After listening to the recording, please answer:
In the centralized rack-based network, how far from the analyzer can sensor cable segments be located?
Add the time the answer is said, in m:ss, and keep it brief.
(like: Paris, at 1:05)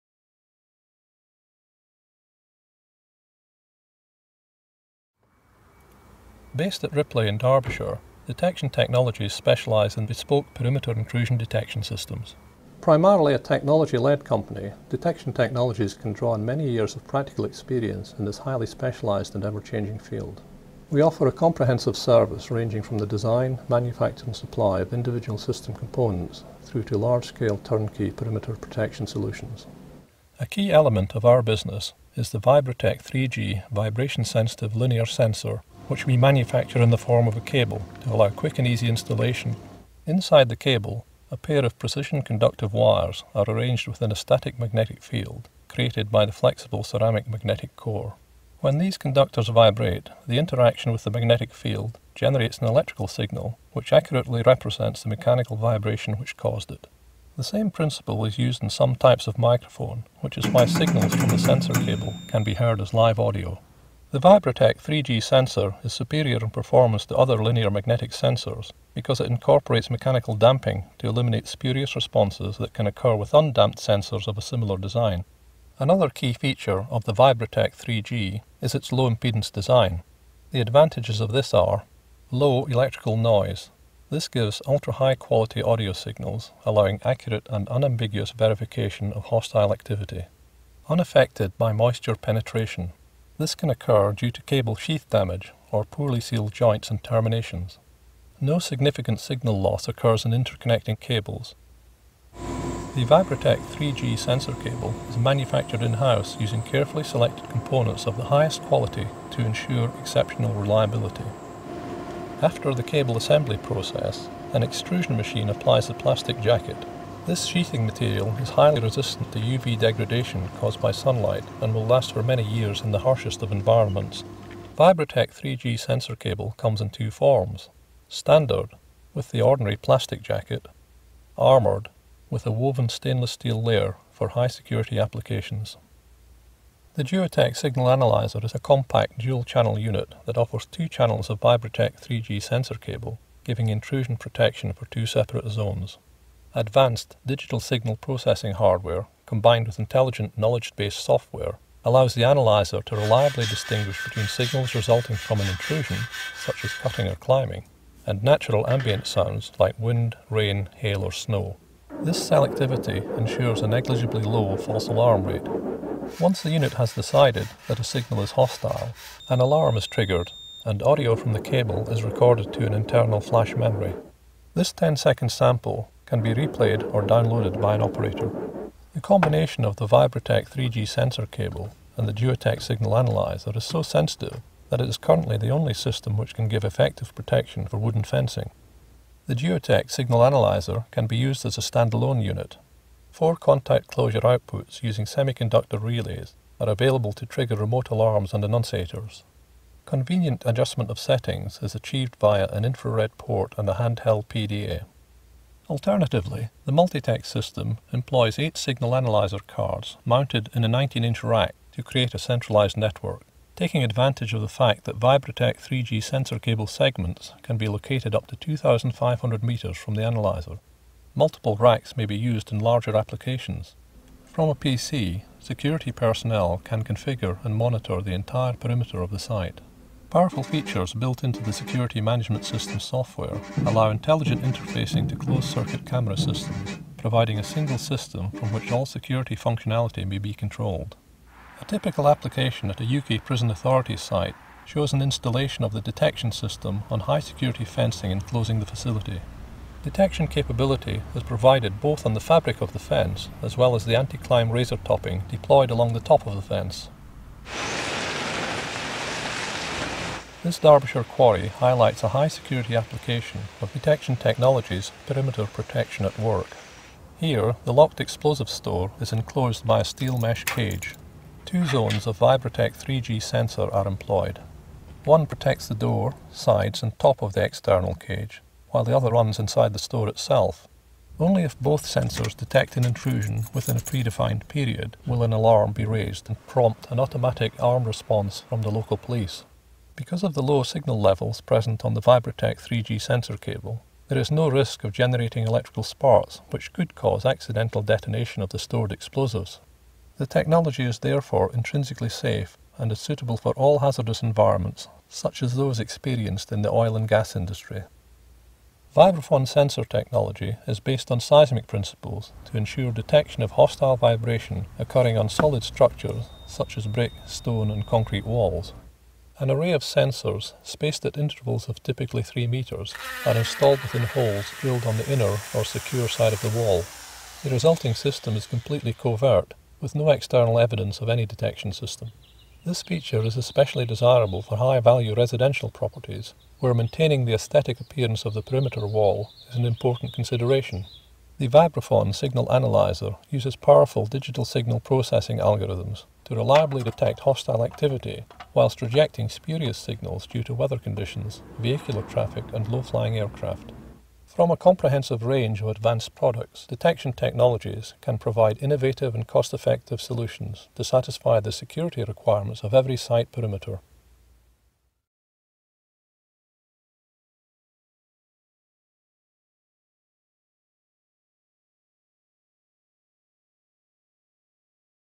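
2,500 meters, at 3:38.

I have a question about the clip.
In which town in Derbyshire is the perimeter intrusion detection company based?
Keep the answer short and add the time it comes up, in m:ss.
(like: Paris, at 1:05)
Ripley, at 0:06.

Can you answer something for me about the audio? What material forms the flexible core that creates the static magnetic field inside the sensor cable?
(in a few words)
Ceramic.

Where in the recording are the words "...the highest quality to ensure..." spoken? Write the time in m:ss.
1:48.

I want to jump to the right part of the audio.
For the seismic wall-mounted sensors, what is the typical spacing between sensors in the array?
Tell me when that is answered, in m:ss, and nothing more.
5:22.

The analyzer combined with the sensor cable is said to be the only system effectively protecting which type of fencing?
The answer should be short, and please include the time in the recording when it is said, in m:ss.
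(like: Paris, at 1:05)
Wooden fencing, at 3:07.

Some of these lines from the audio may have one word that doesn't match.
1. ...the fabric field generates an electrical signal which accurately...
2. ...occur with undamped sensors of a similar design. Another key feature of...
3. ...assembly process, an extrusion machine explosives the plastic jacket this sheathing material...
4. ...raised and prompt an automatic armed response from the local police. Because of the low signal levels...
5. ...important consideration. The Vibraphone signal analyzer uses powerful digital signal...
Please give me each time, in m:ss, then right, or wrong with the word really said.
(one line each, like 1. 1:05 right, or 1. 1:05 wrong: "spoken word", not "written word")
1. 0:51 wrong: "magnetic", not "fabric"
2. 1:12 right
3. 1:53 wrong: "applies", not "explosives"
4. 4:45 right
5. 5:39 right.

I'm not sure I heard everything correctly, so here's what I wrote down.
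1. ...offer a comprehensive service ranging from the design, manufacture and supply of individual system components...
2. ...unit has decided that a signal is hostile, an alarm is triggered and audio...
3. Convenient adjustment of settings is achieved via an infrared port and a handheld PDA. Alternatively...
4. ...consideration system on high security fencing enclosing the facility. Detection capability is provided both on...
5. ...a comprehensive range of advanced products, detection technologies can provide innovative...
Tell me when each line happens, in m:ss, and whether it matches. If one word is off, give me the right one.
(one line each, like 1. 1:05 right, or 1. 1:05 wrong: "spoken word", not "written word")
1. 0:20 right
2. 2:46 right
3. 3:19 right
4. 4:05 wrong: "detection", not "consideration"
5. 5:54 right.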